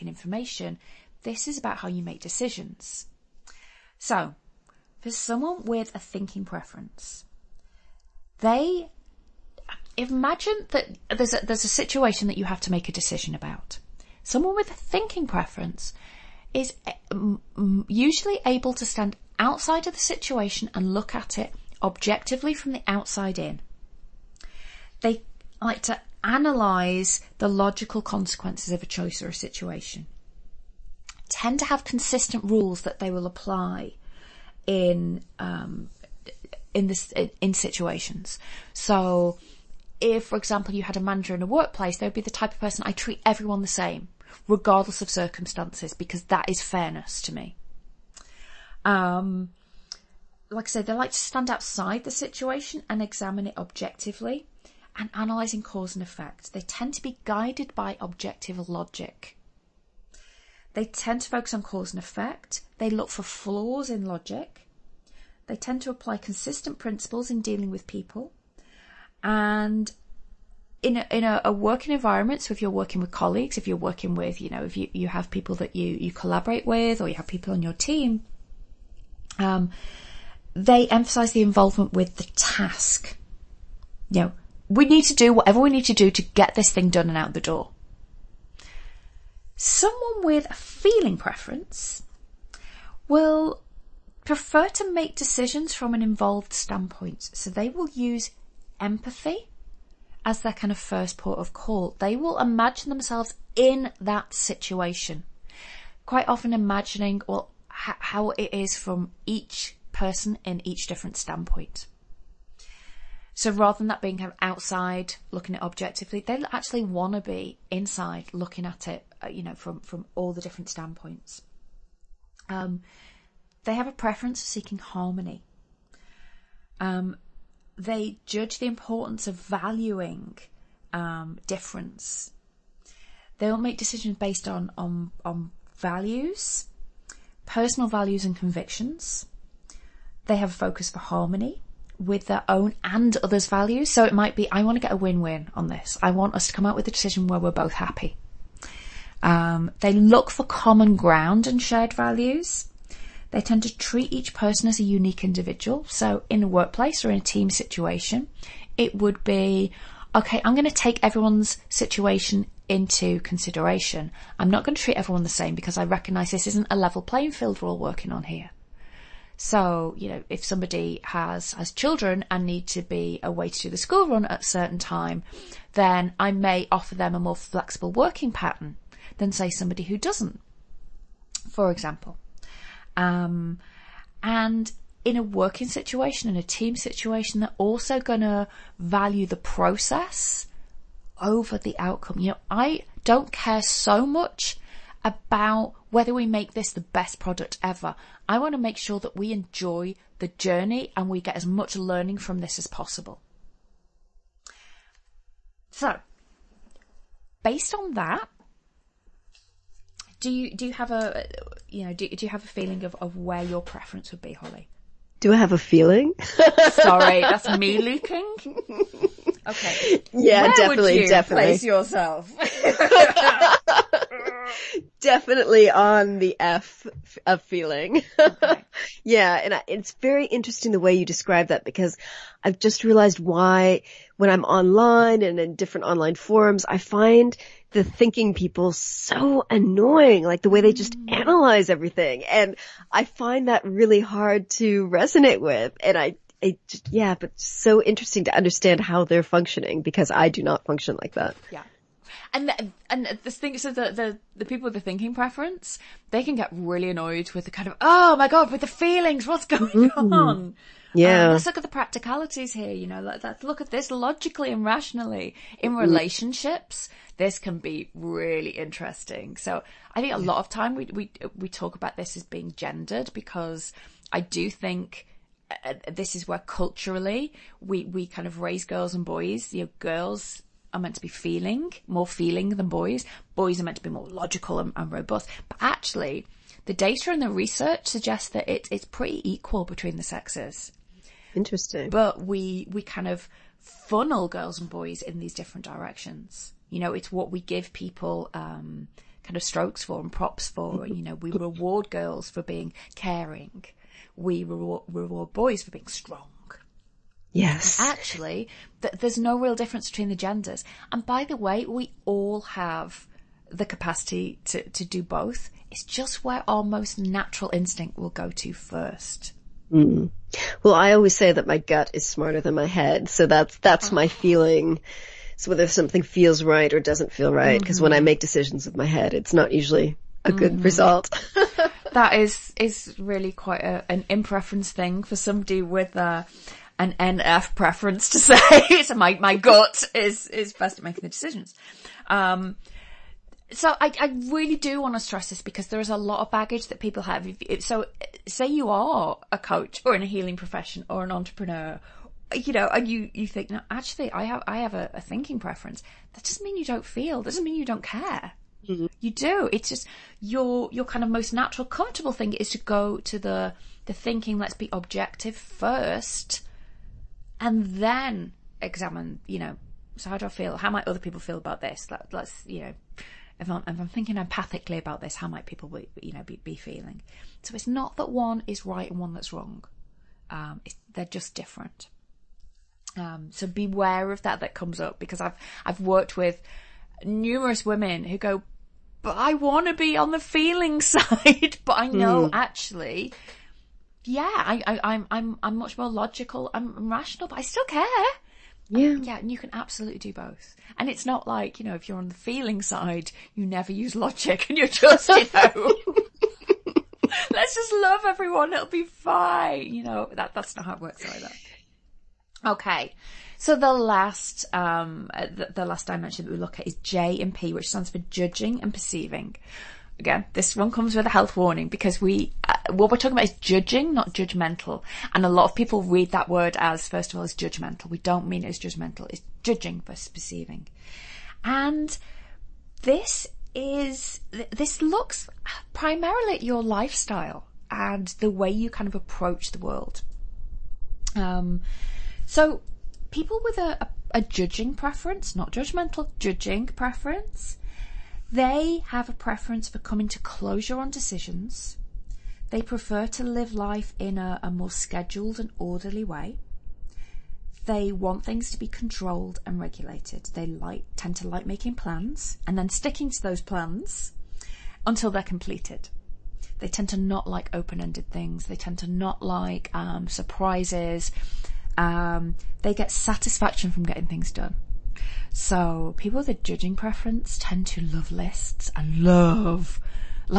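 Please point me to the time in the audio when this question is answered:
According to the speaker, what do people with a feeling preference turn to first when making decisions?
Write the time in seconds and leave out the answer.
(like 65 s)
98 s.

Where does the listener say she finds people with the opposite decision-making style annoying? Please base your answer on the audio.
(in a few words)
online forums.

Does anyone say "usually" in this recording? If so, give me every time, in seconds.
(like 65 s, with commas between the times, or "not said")
17 s, 329 s.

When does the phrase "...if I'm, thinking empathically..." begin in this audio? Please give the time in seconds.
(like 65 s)
373 s.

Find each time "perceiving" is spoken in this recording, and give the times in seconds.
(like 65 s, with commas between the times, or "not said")
418 s, 430 s.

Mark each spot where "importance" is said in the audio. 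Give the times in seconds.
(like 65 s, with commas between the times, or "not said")
128 s.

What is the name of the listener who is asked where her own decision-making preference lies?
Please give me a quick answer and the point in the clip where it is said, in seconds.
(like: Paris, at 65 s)
Holly, at 214 s.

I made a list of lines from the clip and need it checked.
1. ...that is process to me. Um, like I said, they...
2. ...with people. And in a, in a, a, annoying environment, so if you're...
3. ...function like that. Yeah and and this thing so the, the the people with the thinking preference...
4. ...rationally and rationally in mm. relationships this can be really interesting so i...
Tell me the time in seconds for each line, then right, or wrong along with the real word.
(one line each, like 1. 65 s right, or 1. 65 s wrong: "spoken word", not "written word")
1. 46 s wrong: "fairness", not "process"
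2. 67 s wrong: "working", not "annoying"
3. 250 s right
4. 263 s wrong: "logically", not "rationally".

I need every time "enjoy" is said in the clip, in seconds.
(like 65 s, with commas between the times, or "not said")
199 s.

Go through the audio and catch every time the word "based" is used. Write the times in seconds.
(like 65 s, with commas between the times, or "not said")
134 s, 207 s.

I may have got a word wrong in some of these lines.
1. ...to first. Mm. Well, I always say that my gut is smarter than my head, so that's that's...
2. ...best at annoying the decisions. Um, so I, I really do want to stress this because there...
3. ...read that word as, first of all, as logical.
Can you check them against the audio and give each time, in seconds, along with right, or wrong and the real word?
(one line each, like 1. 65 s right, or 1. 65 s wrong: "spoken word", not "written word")
1. 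318 s right
2. 340 s wrong: "making", not "annoying"
3. 425 s wrong: "judgmental", not "logical".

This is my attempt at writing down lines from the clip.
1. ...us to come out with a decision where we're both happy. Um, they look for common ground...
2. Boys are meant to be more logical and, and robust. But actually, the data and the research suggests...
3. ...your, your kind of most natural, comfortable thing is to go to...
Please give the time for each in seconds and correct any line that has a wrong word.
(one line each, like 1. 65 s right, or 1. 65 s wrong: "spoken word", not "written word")
1. 146 s right
2. 283 s right
3. 360 s right.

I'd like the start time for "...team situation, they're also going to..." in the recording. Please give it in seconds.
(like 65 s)
186 s.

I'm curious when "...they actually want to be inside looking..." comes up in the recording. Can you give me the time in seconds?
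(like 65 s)
116 s.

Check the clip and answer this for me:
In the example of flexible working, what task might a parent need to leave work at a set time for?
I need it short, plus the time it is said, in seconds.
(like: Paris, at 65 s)
the school run, at 173 s.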